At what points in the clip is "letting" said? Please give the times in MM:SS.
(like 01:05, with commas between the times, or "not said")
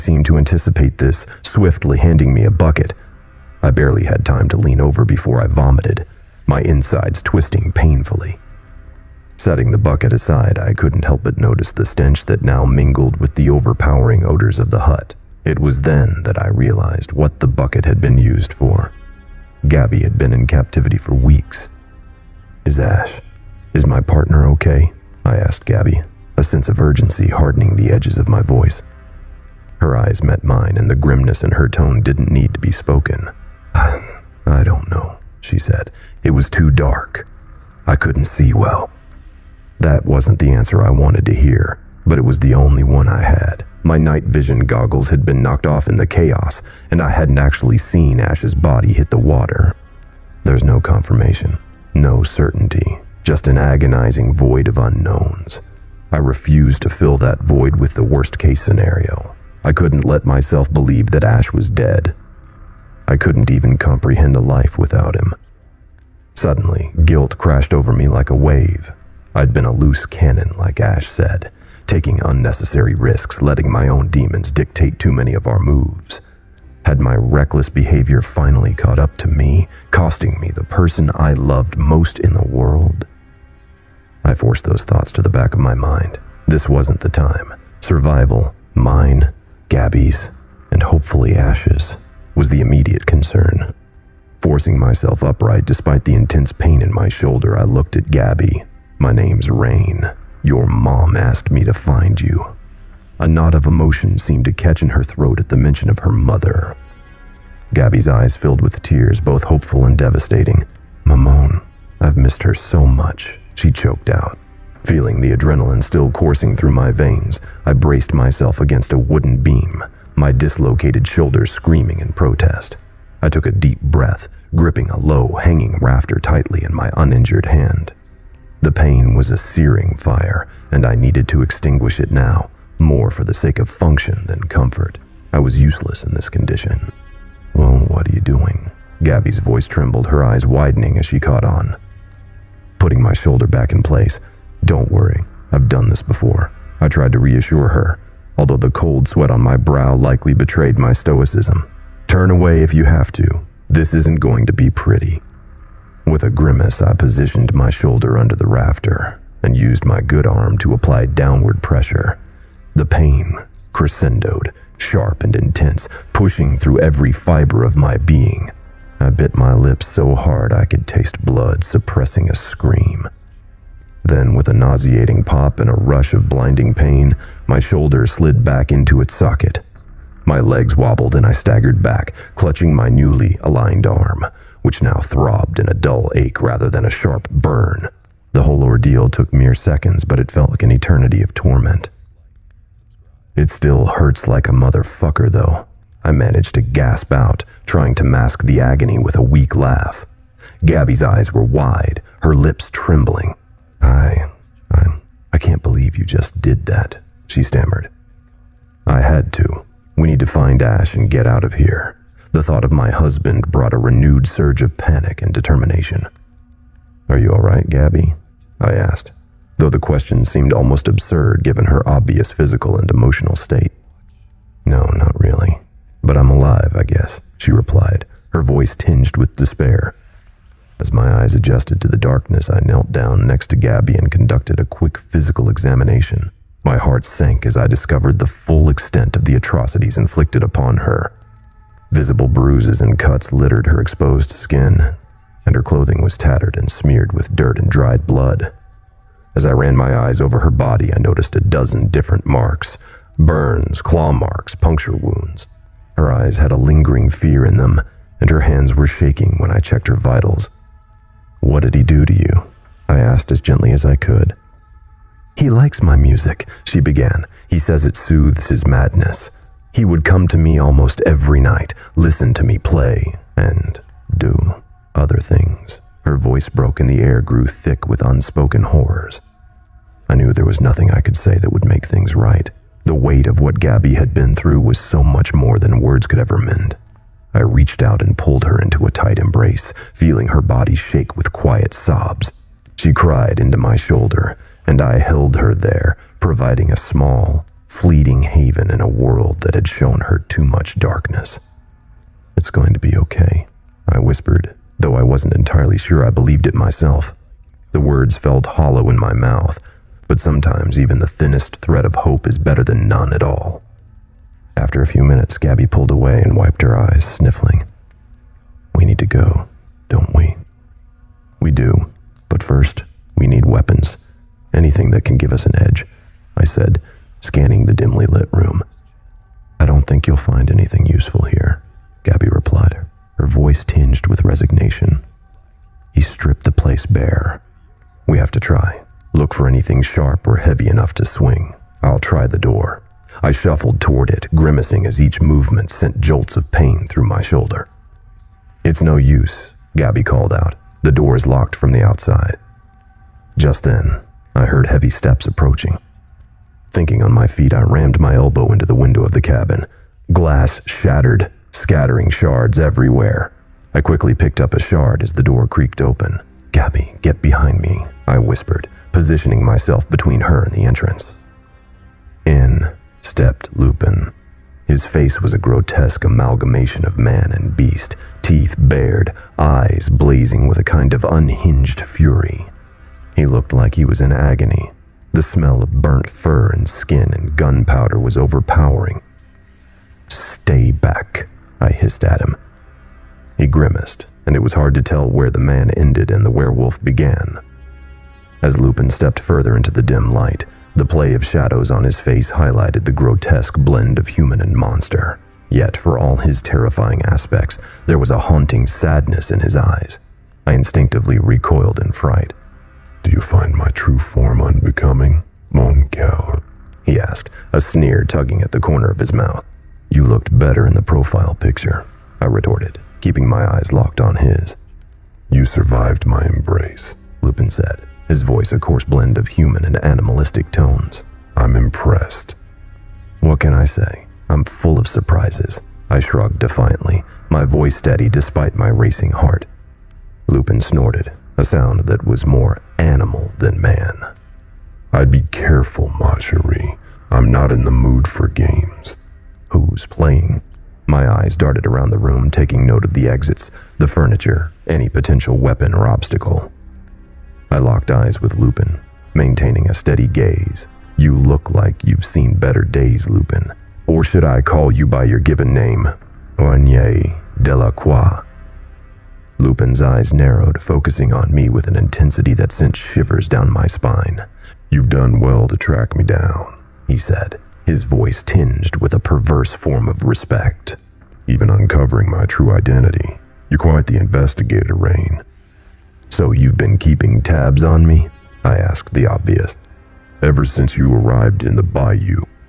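01:13.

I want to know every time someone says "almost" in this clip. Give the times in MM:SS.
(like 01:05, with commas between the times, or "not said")
03:40, 04:30.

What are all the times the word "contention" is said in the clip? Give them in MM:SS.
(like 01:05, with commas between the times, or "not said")
not said.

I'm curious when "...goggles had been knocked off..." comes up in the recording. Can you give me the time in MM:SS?
00:44.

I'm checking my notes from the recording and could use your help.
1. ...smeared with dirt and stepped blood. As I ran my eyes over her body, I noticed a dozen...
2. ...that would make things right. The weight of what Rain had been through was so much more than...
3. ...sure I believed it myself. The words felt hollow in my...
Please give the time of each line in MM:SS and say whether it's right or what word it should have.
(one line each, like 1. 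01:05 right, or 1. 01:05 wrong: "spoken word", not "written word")
1. 04:06 wrong: "dried", not "stepped"
2. 04:41 wrong: "Gabby", not "Rain"
3. 05:05 right.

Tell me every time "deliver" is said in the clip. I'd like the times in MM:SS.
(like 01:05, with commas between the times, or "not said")
not said.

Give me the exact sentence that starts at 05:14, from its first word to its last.
After a few minutes, Gabby pulled away and wiped her eyes, sniffling.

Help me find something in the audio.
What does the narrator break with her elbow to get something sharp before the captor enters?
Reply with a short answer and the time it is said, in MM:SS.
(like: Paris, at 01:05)
the window, at 05:58.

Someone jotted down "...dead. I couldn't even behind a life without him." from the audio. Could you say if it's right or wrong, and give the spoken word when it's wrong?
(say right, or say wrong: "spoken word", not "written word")
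wrong: "comprehend", not "behind".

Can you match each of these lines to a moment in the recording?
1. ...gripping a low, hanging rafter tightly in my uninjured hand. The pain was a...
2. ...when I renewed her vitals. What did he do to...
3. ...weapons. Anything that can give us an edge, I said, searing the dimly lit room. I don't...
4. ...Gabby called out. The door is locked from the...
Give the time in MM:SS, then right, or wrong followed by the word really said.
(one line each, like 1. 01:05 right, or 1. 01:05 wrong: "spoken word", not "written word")
1. 02:04 right
2. 04:19 wrong: "checked", not "renewed"
3. 05:23 wrong: "scanning", not "searing"
4. 05:49 right.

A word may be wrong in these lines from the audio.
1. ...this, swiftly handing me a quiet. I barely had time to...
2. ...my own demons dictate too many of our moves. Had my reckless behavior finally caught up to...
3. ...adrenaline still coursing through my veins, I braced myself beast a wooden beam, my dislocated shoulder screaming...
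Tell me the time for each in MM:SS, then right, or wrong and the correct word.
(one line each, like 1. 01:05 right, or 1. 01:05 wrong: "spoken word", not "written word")
1. 00:00 wrong: "bucket", not "quiet"
2. 01:13 right
3. 01:55 wrong: "against", not "beast".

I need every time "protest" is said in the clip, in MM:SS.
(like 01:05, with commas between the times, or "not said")
02:02.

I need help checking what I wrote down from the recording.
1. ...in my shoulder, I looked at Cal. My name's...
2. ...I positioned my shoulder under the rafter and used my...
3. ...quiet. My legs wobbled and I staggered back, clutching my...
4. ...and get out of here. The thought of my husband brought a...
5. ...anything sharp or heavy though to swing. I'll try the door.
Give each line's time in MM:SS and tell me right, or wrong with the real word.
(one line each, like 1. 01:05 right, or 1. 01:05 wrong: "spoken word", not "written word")
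1. 01:36 wrong: "Gabby", not "Cal"
2. 02:36 right
3. 02:59 wrong: "socket", not "quiet"
4. 03:30 right
5. 05:39 wrong: "enough", not "though".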